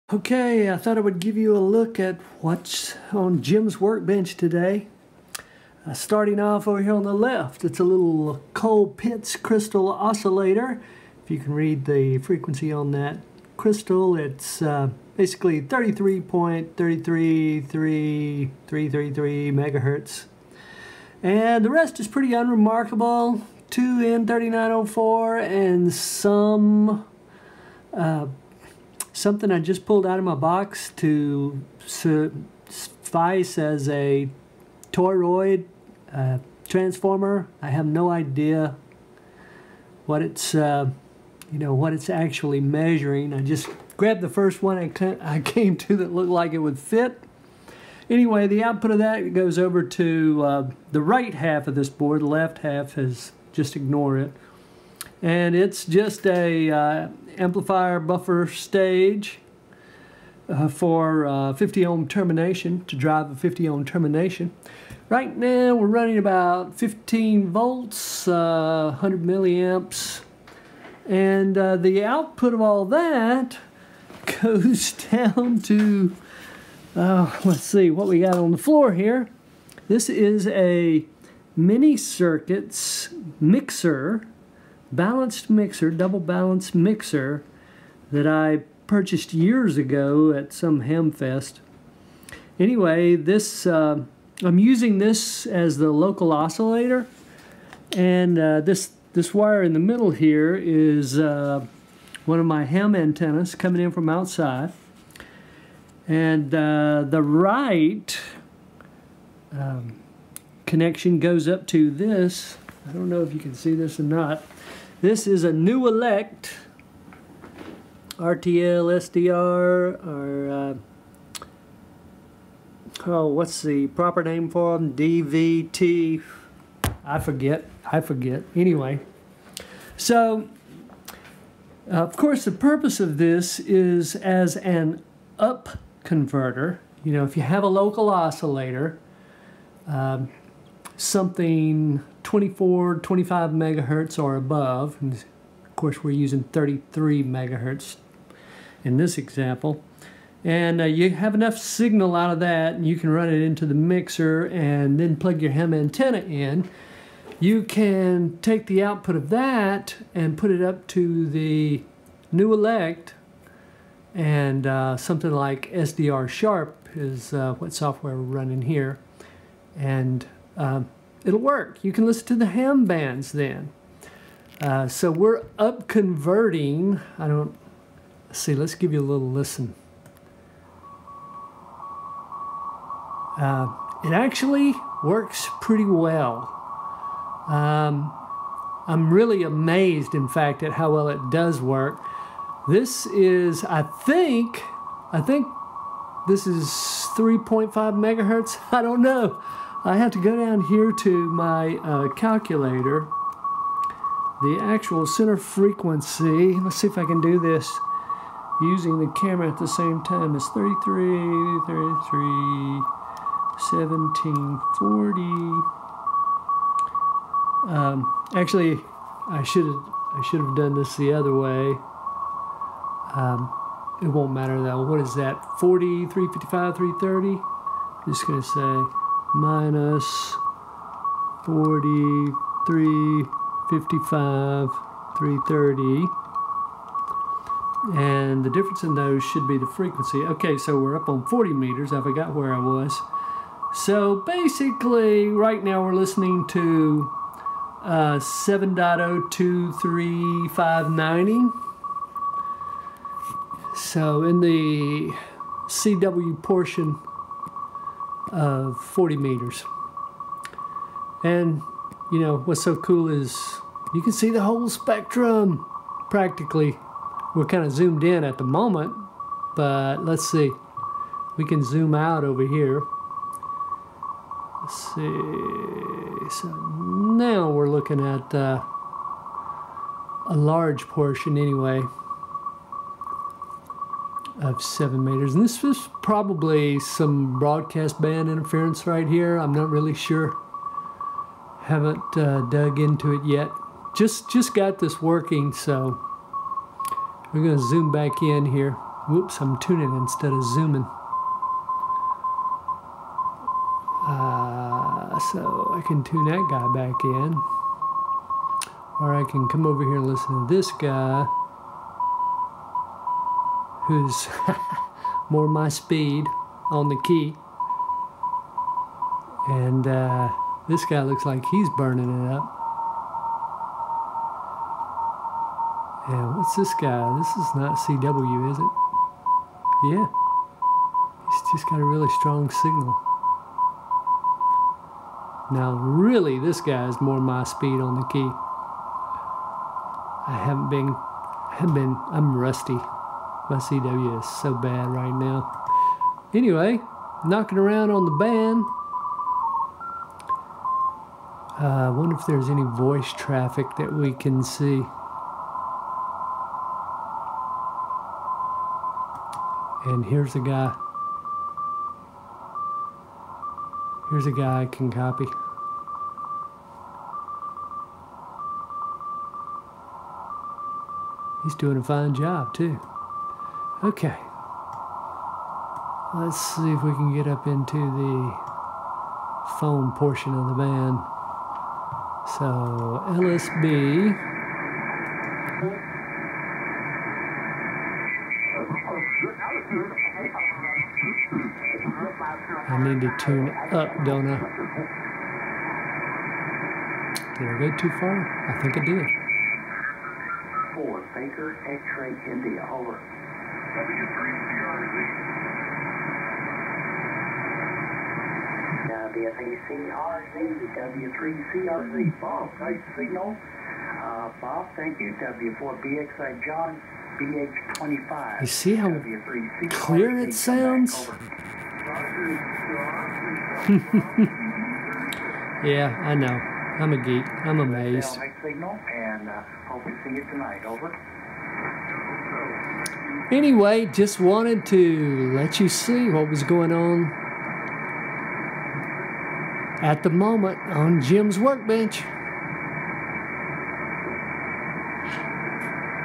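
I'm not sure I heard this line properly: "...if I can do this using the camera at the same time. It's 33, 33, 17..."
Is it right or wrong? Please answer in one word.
right.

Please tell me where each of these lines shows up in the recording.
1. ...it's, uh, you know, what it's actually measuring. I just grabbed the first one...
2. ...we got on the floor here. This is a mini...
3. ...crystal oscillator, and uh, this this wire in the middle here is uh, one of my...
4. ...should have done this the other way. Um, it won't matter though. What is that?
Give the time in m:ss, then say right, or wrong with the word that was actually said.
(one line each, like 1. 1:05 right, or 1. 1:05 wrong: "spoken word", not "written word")
1. 0:40 right
2. 1:18 right
3. 1:35 wrong: "local", not "crystal"
4. 3:40 right.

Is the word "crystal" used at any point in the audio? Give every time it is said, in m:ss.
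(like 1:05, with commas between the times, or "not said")
0:09, 0:13.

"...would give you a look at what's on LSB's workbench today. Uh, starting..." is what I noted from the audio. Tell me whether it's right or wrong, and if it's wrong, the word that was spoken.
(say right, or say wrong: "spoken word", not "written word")
wrong: "Jim", not "LSB".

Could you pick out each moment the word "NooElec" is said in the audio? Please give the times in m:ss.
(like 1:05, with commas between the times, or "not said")
1:55, 2:42.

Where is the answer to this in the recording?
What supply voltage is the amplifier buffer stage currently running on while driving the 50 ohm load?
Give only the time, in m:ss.
1:06.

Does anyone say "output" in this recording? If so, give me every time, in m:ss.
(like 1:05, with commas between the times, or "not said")
0:48, 1:12, 2:38.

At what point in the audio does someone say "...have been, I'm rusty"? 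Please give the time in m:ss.
5:41.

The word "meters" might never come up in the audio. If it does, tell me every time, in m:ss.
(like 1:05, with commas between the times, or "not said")
4:01, 4:19, 4:45.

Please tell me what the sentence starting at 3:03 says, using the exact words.
Uh, it actually works pretty well.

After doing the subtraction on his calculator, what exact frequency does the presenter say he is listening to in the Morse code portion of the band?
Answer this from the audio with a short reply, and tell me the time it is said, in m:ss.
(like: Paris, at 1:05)
7.023590, at 4:08.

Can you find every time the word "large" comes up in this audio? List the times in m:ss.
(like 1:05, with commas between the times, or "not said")
4:40.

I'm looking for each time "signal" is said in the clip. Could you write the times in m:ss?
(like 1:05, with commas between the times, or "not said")
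2:31, 5:32, 6:52, 7:08.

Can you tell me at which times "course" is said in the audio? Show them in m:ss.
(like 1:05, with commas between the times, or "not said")
2:12, 2:25.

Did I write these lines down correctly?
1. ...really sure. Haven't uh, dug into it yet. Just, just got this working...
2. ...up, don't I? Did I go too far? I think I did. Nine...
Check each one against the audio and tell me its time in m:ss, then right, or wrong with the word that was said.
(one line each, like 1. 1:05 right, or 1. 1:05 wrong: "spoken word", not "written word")
1. 4:49 right
2. 6:33 wrong: "Four", not "Nine".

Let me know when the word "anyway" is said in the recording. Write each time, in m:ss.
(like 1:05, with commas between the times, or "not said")
0:48, 1:32, 2:08, 4:41, 5:46, 7:13.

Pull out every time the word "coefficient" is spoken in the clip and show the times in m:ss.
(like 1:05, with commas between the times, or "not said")
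not said.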